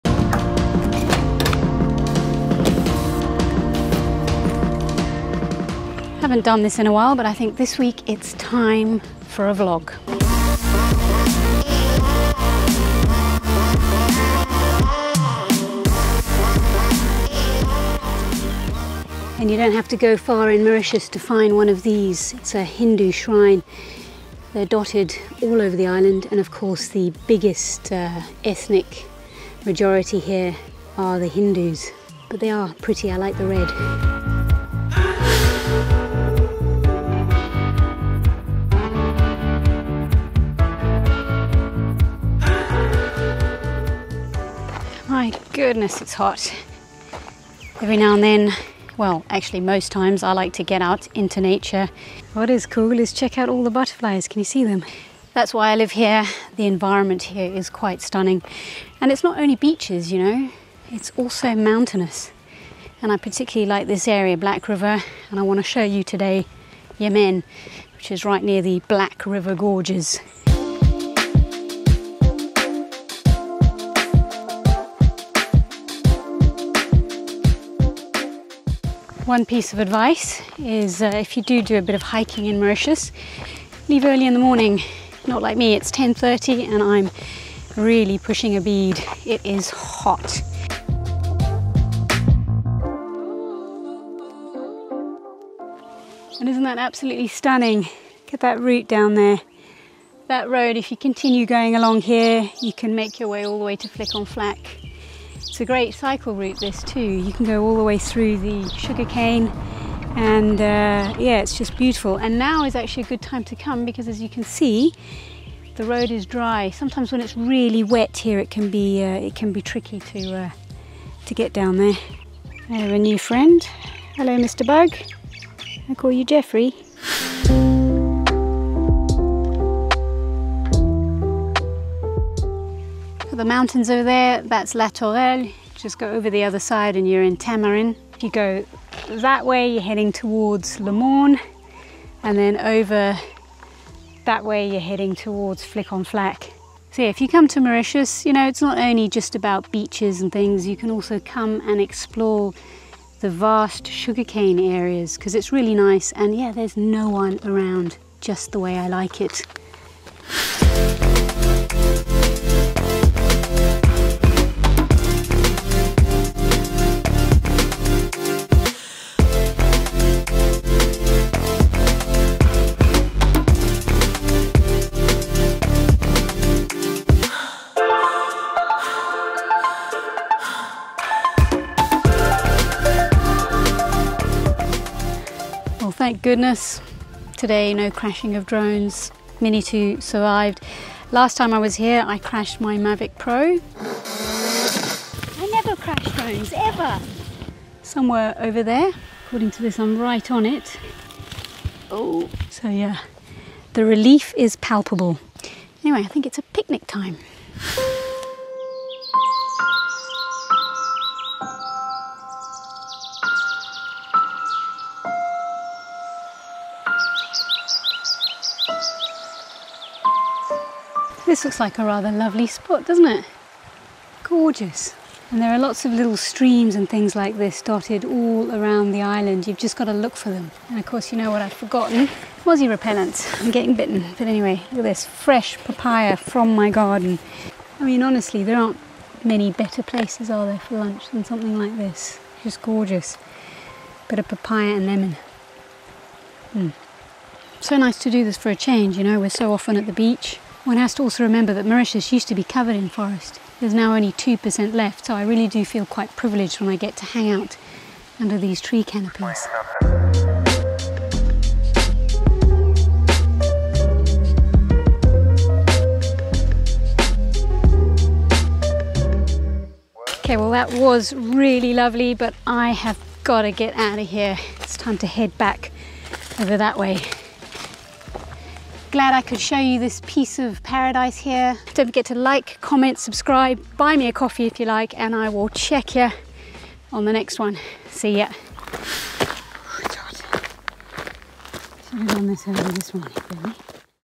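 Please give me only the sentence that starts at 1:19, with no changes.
one piece of advice is uh, if you do do a bit of hiking in Mauritius, leave early in the morning.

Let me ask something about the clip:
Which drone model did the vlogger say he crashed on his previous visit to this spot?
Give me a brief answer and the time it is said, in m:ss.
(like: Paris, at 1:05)
Mavic Pro, at 3:12.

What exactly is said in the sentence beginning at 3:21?
Oh, so yeah, the relief is palpable.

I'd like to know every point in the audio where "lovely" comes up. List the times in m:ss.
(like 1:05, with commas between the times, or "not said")
3:42, 4:31.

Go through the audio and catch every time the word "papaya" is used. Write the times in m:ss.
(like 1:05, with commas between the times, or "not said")
3:55, 4:04.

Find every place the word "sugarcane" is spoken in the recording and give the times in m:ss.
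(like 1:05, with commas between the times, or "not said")
1:48, 2:33.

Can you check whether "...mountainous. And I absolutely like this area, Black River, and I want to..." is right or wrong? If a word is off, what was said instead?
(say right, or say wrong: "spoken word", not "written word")
wrong: "particularly", not "absolutely".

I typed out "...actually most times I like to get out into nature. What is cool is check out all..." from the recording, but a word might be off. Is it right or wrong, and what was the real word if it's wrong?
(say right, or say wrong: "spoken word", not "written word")
right.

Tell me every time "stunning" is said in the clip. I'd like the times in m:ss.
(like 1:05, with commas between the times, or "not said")
0:58, 1:37.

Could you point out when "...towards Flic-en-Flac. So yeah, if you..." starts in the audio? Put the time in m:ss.
2:25.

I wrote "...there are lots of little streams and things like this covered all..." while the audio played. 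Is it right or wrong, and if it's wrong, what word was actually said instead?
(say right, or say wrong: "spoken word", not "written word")
wrong: "dotted", not "covered".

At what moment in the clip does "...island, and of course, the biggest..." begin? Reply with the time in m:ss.
0:25.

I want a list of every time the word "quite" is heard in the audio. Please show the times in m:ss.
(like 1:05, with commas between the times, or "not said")
0:57, 4:15.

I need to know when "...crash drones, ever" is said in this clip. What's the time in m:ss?
3:15.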